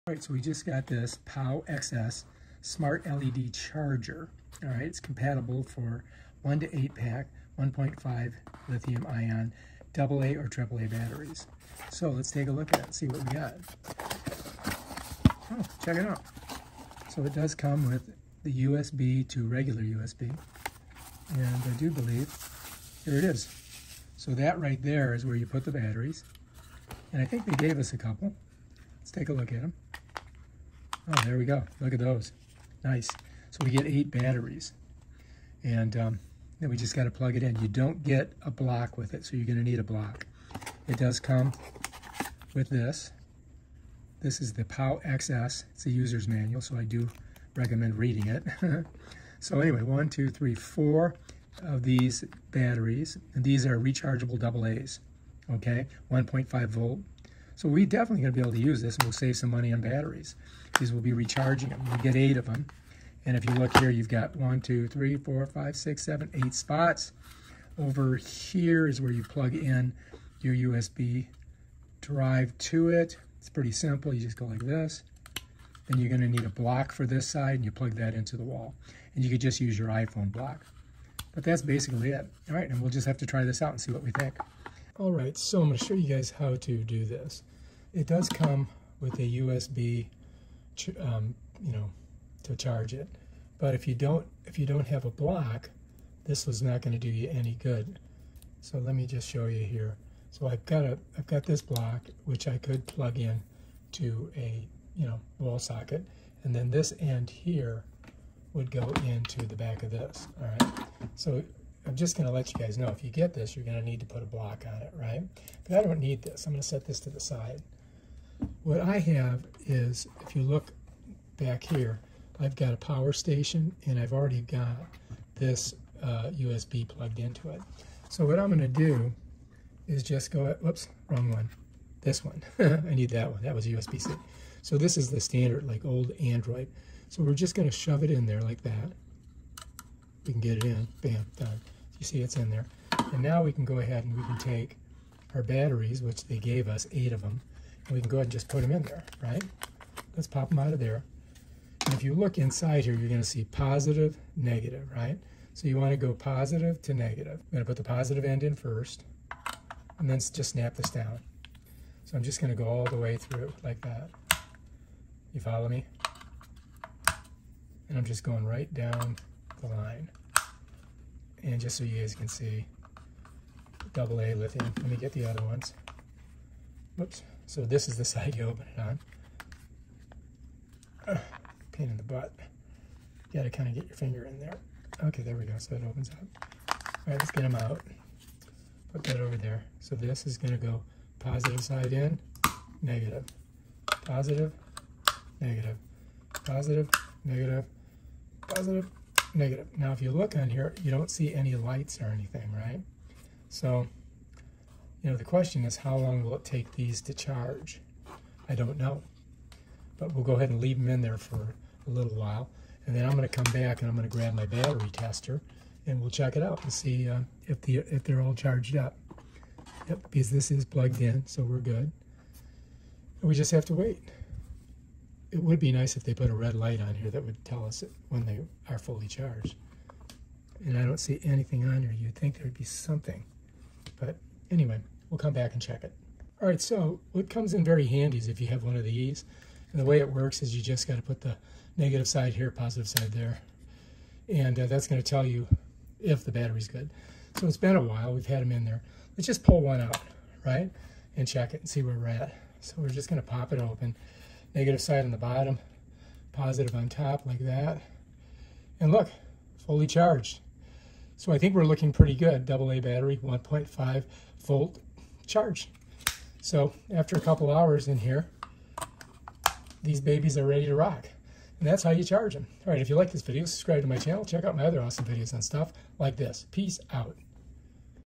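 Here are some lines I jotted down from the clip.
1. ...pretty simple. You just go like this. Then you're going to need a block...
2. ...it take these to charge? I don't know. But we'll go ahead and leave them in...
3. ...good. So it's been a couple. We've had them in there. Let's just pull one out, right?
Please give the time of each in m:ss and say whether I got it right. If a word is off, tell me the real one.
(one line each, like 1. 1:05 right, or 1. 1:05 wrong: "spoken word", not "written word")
1. 1:13 right
2. 3:26 right
3. 4:06 wrong: "while", not "couple".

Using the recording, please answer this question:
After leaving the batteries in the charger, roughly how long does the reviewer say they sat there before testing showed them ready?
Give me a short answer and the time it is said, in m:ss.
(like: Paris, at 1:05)
A couple hours, at 4:27.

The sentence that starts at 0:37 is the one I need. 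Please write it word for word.
You don't get a block with it, so you're going to need a block.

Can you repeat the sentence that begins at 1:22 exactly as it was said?
All right, and we'll just have to try this out and see what we think.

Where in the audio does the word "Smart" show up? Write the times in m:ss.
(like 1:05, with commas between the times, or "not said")
0:02.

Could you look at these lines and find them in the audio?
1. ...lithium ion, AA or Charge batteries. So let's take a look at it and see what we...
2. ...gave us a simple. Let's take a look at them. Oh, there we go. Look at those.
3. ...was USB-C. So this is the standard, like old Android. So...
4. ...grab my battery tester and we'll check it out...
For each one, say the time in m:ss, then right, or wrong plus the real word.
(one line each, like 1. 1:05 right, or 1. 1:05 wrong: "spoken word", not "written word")
1. 0:08 wrong: "AAA", not "Charge"
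2. 0:27 wrong: "couple", not "simple"
3. 2:13 right
4. 3:34 right.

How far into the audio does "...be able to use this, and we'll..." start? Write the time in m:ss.
0:58.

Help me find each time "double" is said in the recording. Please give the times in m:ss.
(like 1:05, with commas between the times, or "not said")
0:54, 2:53, 4:22.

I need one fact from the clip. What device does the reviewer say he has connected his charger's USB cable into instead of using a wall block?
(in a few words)
Power station.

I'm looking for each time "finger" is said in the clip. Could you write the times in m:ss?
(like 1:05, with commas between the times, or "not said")
3:03.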